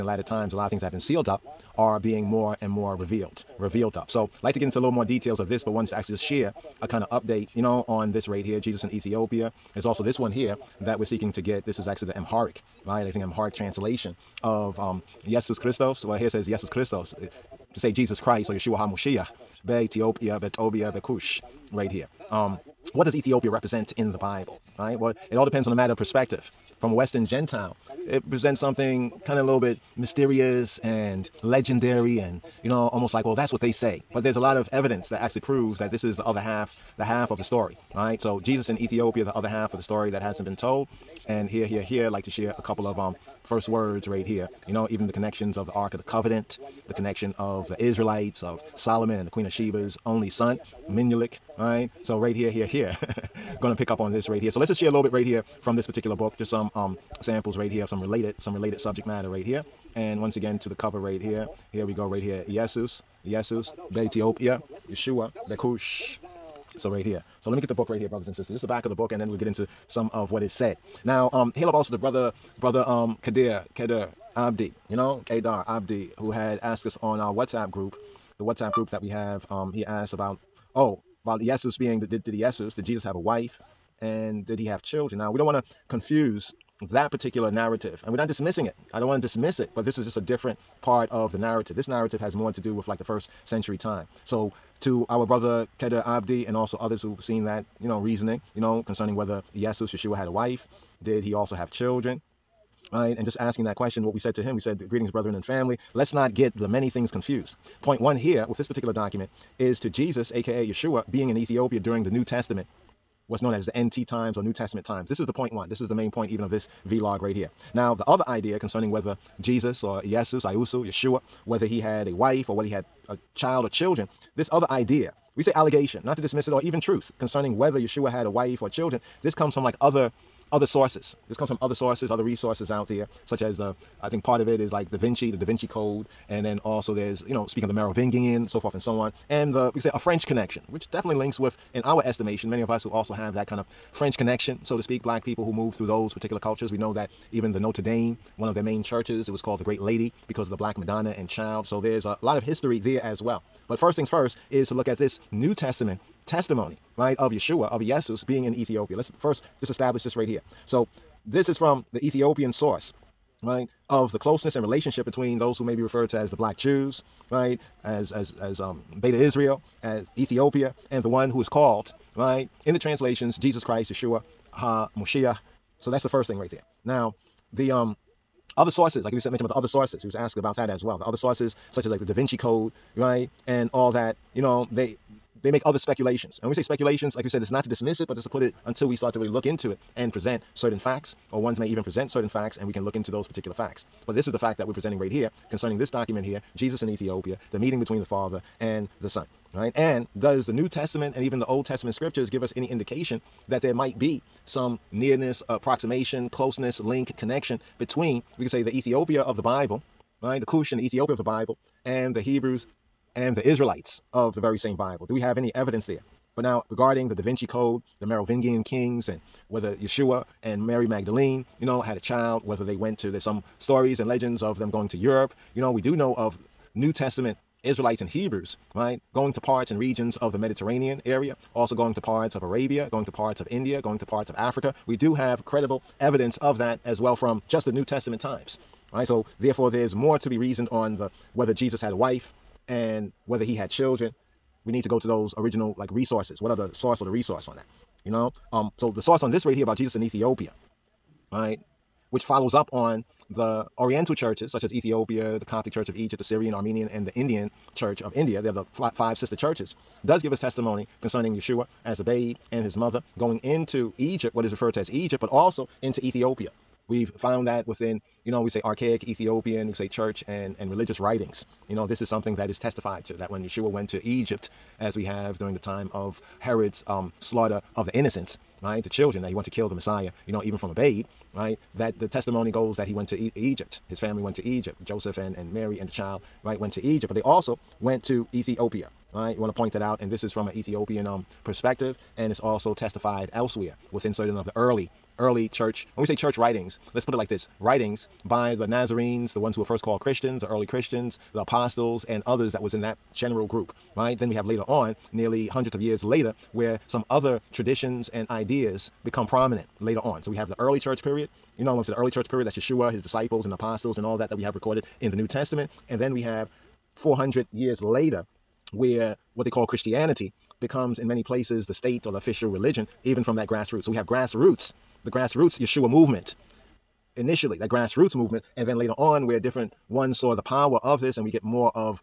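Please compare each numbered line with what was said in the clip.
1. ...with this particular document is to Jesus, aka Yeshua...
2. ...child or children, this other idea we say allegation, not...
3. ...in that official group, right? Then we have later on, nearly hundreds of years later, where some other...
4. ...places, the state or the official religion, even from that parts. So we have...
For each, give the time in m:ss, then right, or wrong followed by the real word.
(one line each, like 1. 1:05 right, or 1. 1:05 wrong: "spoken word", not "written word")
1. 1:48 right
2. 2:03 right
3. 5:02 wrong: "general", not "official"
4. 5:21 wrong: "grassroots", not "parts".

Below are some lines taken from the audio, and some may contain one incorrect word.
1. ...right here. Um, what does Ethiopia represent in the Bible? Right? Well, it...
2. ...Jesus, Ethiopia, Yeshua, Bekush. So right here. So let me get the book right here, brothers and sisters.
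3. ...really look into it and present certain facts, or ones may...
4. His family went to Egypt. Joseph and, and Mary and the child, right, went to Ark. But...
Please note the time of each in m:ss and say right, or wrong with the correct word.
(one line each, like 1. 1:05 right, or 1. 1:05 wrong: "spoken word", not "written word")
1. 0:21 right
2. 1:03 right
3. 3:09 right
4. 4:43 wrong: "Egypt", not "Ark".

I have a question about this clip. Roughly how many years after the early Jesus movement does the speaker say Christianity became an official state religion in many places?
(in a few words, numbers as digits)
400.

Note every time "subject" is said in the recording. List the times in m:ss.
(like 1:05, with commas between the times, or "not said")
0:58.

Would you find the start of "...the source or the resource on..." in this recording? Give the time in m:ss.
4:06.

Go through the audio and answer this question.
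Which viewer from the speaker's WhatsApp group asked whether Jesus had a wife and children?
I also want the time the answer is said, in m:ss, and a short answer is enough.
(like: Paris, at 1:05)
Kadir Abdi, at 1:13.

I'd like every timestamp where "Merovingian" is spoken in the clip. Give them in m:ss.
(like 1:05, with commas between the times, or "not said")
2:17, 3:38.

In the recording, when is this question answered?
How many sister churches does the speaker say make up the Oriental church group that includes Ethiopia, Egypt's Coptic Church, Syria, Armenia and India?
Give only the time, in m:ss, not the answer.
4:18.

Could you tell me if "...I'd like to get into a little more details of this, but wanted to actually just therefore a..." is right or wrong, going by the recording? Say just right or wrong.
wrong.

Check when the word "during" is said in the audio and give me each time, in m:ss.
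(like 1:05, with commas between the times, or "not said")
1:51, 4:35.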